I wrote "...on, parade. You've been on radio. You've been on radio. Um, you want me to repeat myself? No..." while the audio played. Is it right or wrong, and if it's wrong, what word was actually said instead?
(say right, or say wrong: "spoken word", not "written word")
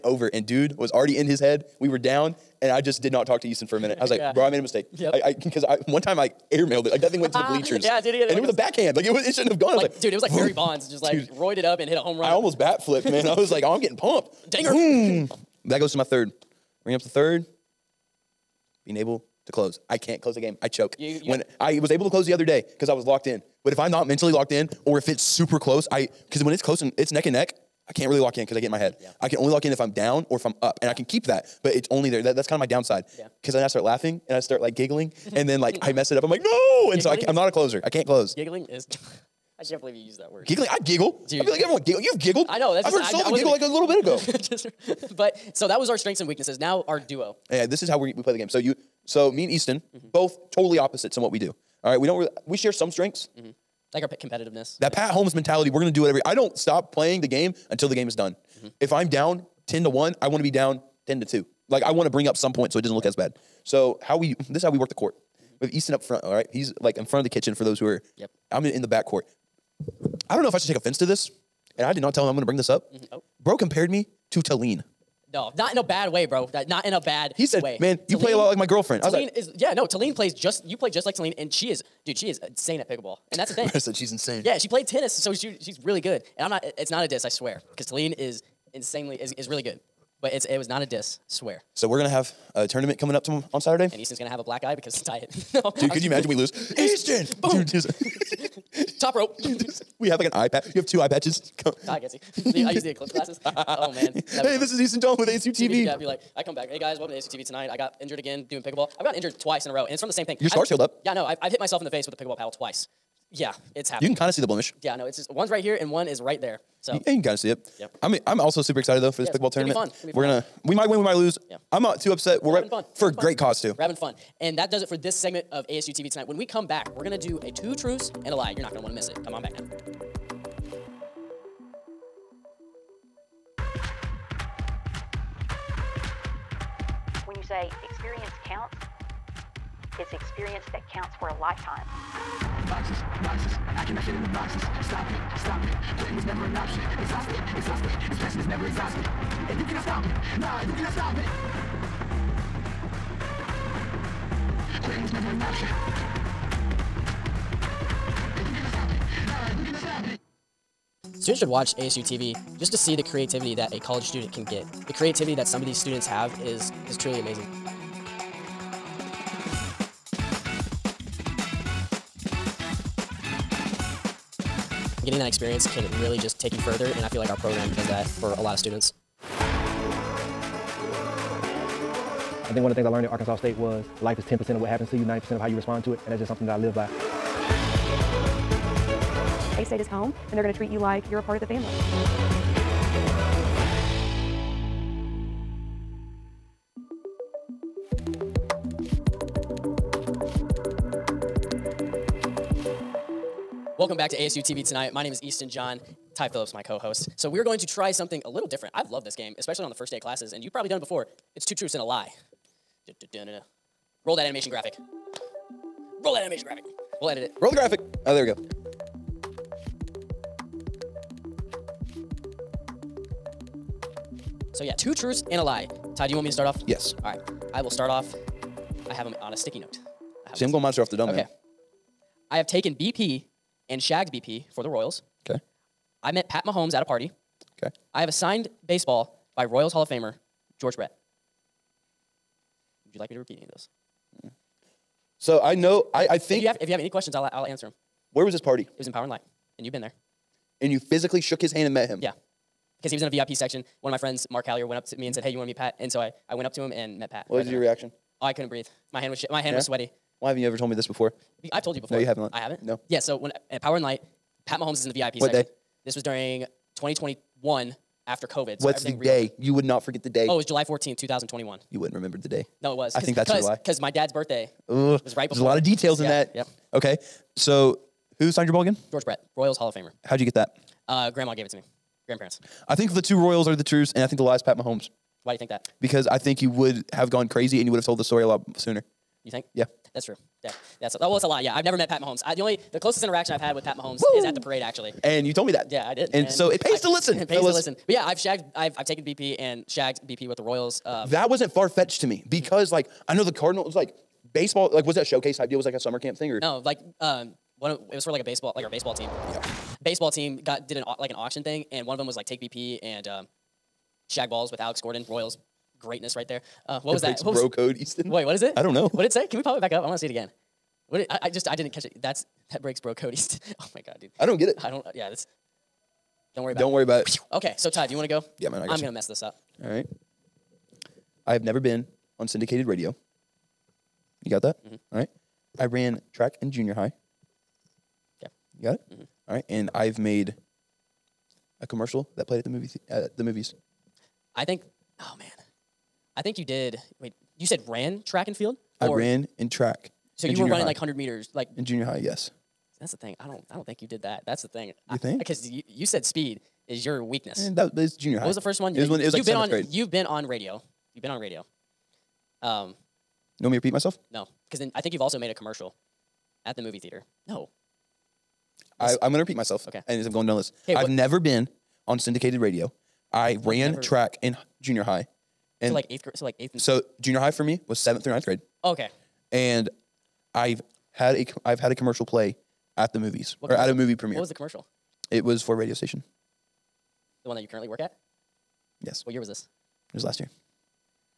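wrong: "grade", not "parade".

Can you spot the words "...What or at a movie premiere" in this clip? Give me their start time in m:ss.
6:23.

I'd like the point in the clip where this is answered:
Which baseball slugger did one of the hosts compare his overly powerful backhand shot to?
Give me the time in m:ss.
0:10.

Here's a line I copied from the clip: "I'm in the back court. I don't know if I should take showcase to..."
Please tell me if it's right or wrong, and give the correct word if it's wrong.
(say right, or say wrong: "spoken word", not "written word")
wrong: "offense", not "showcase".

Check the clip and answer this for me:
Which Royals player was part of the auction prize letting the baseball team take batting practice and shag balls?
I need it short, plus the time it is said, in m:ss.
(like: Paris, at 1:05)
Alex Gordon, at 5:14.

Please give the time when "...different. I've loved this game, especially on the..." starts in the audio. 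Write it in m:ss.
3:28.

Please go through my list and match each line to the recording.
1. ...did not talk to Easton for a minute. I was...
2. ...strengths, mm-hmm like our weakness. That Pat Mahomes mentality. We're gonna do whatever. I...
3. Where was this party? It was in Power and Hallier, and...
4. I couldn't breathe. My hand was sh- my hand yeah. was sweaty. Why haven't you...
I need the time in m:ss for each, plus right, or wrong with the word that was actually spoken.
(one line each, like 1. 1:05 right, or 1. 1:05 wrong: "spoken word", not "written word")
1. 0:03 right
2. 0:52 wrong: "competitiveness", not "weakness"
3. 4:08 wrong: "Light", not "Hallier"
4. 4:18 right.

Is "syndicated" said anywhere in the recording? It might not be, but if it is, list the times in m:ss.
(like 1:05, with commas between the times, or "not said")
5:32, 6:11.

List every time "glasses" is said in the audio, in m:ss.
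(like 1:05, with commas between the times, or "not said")
1:43.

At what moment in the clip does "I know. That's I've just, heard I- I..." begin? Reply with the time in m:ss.
0:42.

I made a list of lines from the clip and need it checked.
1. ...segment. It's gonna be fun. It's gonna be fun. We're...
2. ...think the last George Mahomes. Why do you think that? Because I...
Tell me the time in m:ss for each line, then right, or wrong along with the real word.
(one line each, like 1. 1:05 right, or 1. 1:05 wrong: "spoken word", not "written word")
1. 1:59 wrong: "tournament", not "segment"
2. 4:44 wrong: "Pat", not "George".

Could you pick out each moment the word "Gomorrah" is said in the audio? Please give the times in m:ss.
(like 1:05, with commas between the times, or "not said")
not said.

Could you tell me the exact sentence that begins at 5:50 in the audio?
like hundred meters, like in junior high.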